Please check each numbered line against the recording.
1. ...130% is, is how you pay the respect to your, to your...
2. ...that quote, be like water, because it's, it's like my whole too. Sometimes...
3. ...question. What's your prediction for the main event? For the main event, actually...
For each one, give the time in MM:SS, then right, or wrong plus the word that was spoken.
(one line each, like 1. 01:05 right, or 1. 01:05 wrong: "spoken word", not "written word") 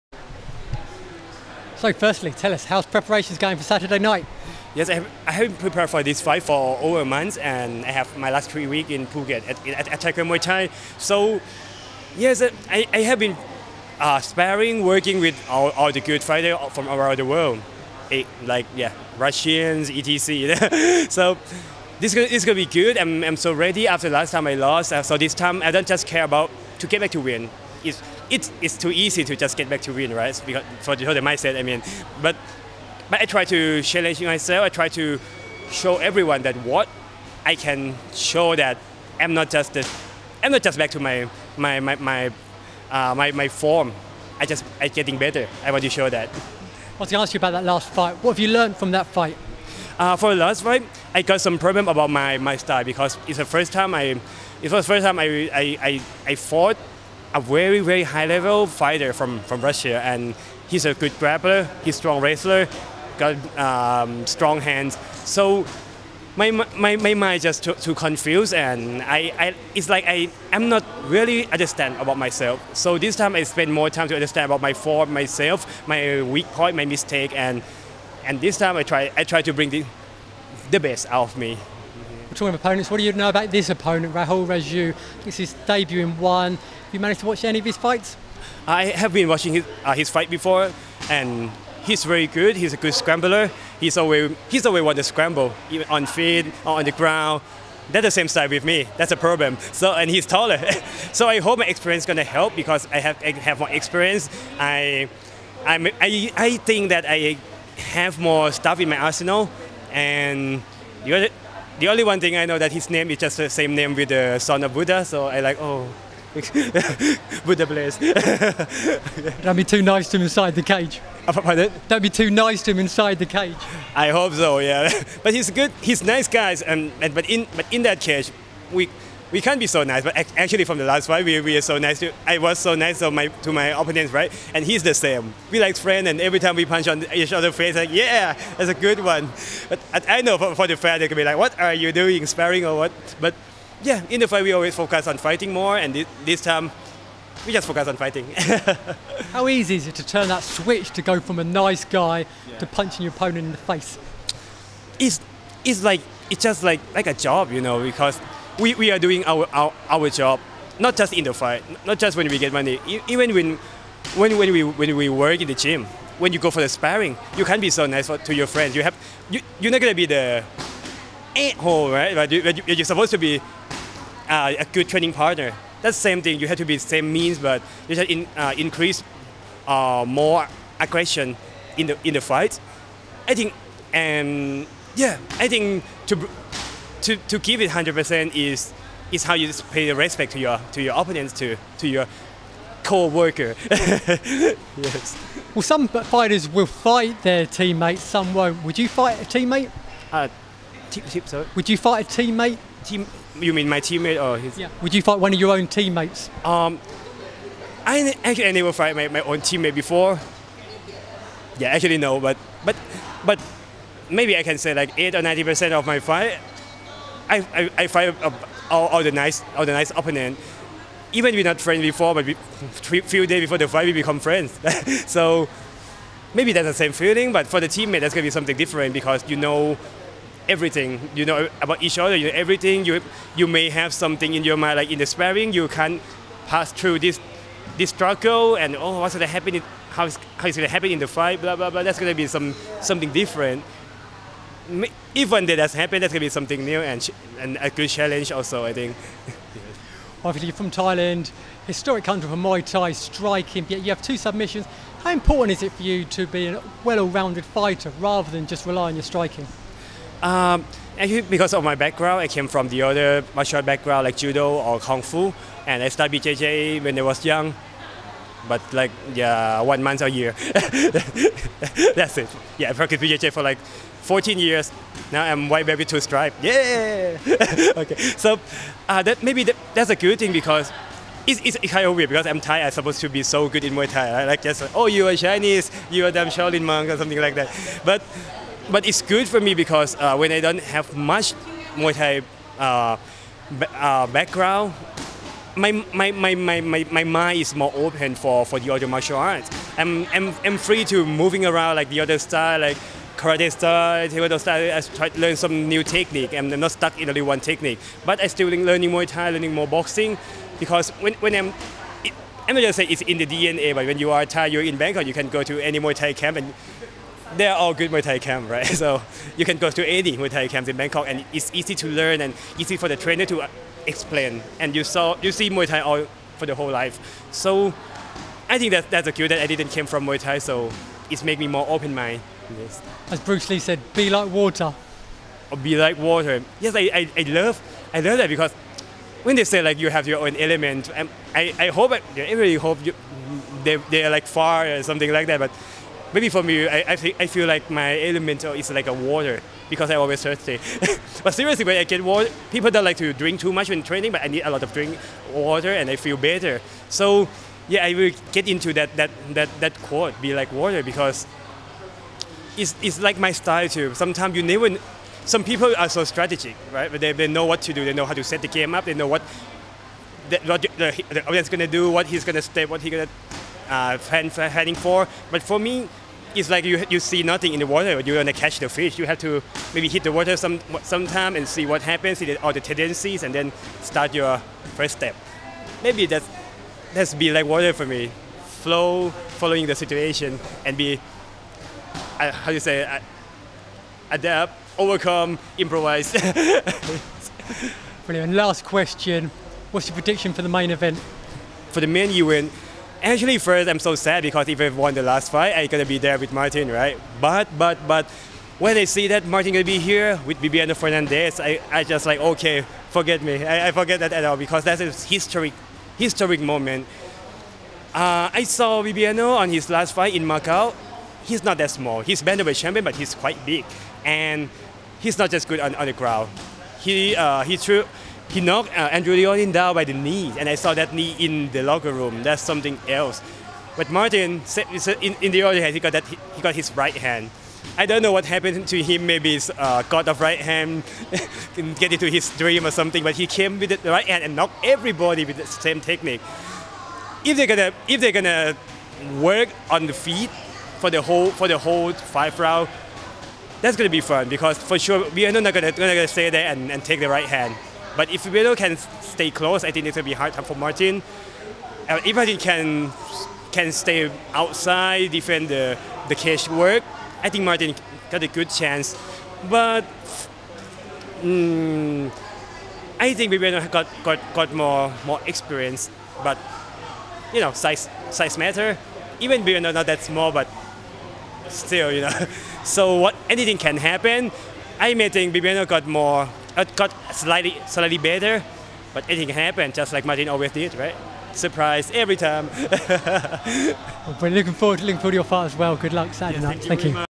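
1. 03:07 wrong: "100", not "130"
2. 05:59 wrong: "style", not "whole"
3. 06:38 right.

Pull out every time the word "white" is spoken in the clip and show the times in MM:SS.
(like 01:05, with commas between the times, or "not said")
04:35.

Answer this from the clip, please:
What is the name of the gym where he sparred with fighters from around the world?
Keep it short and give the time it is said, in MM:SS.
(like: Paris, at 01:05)
Attacker Muay Thai, at 00:09.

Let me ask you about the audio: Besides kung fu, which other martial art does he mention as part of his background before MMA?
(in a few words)
judo.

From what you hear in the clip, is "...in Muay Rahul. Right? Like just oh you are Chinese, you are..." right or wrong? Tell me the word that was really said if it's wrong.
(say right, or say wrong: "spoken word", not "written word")
wrong: "Thai", not "Rahul".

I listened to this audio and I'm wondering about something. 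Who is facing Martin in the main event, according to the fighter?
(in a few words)
Bibiano Fernandes.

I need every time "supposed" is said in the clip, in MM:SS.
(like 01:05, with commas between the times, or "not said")
02:52, 04:42.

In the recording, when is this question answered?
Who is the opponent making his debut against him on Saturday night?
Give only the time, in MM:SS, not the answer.
01:24.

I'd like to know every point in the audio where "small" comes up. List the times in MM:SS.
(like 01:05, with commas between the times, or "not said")
07:01, 08:00.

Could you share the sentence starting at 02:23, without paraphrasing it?
But yeah, in the fight, we always focus on fighting more, and this, this time, we just focus on fighting.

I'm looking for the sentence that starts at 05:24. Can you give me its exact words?
And you saw you see Muay Thai all for the whole life.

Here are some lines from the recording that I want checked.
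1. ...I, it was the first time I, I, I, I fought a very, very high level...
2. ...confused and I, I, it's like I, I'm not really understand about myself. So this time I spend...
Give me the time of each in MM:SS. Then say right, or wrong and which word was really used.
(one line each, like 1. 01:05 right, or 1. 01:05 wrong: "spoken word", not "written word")
1. 00:53 right
2. 01:07 right.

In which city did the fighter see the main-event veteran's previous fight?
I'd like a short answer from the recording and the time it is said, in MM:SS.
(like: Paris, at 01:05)
Macau, at 07:00.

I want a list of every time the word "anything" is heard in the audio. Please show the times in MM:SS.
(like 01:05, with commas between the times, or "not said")
08:03, 08:09.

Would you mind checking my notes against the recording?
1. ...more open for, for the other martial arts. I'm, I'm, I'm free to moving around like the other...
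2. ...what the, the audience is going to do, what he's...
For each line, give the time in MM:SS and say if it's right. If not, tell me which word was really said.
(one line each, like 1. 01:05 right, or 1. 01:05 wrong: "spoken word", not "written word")
1. 04:57 right
2. 06:10 right.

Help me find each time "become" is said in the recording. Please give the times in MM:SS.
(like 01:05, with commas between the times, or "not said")
03:43.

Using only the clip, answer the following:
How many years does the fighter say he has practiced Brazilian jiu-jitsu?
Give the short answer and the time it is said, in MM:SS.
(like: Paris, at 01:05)
14, at 04:34.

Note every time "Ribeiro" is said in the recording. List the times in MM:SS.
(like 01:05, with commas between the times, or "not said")
07:38, 07:53, 07:59.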